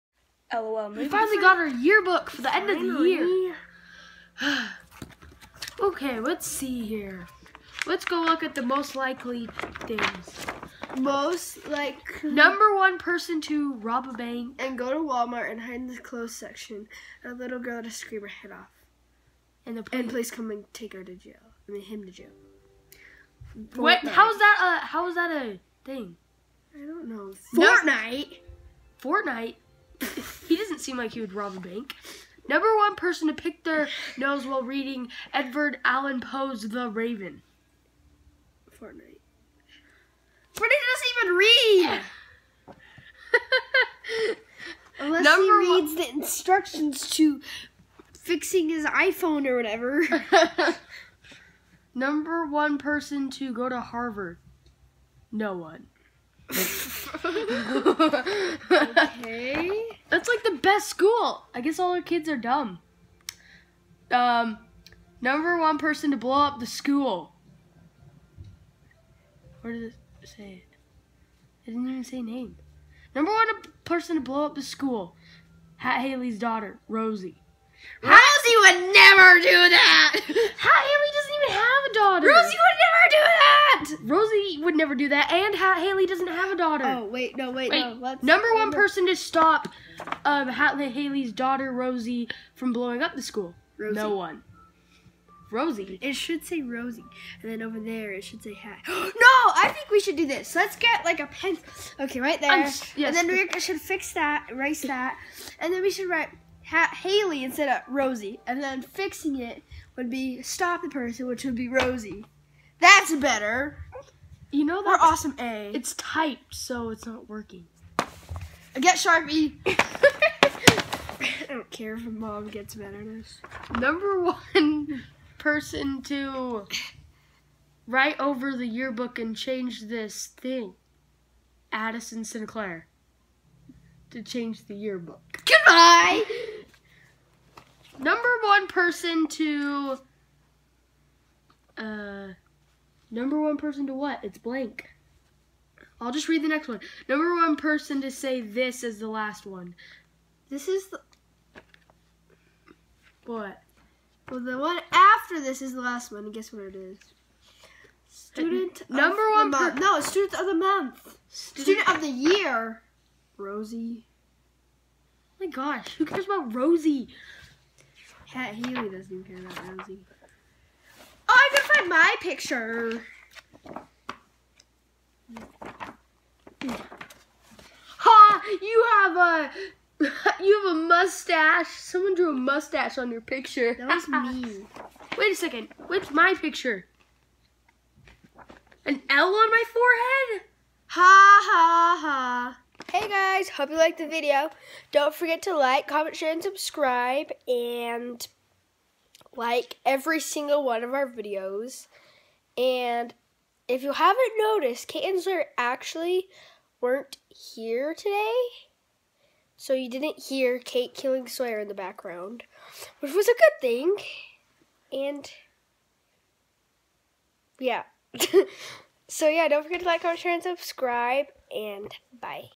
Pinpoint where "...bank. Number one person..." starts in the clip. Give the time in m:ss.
0:31.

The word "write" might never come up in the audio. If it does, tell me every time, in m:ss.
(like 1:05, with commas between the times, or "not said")
1:46, 2:07.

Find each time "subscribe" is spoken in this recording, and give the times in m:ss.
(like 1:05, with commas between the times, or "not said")
3:16, 3:40.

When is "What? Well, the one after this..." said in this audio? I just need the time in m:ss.
2:33.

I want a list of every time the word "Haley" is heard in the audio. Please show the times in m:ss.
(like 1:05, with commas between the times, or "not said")
1:16, 1:20, 1:25, 1:30, 1:46.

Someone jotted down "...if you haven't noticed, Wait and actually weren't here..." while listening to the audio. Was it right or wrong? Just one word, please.
wrong.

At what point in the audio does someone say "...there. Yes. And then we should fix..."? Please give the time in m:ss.
1:42.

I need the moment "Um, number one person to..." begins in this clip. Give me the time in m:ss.
1:04.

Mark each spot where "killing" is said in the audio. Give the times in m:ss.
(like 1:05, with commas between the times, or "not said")
3:30.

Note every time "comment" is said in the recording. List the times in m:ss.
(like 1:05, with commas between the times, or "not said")
3:15, 3:40.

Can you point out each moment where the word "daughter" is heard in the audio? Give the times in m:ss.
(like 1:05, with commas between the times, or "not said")
1:16, 1:21, 1:26, 1:31.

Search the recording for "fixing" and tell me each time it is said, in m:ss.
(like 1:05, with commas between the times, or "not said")
0:48, 1:48.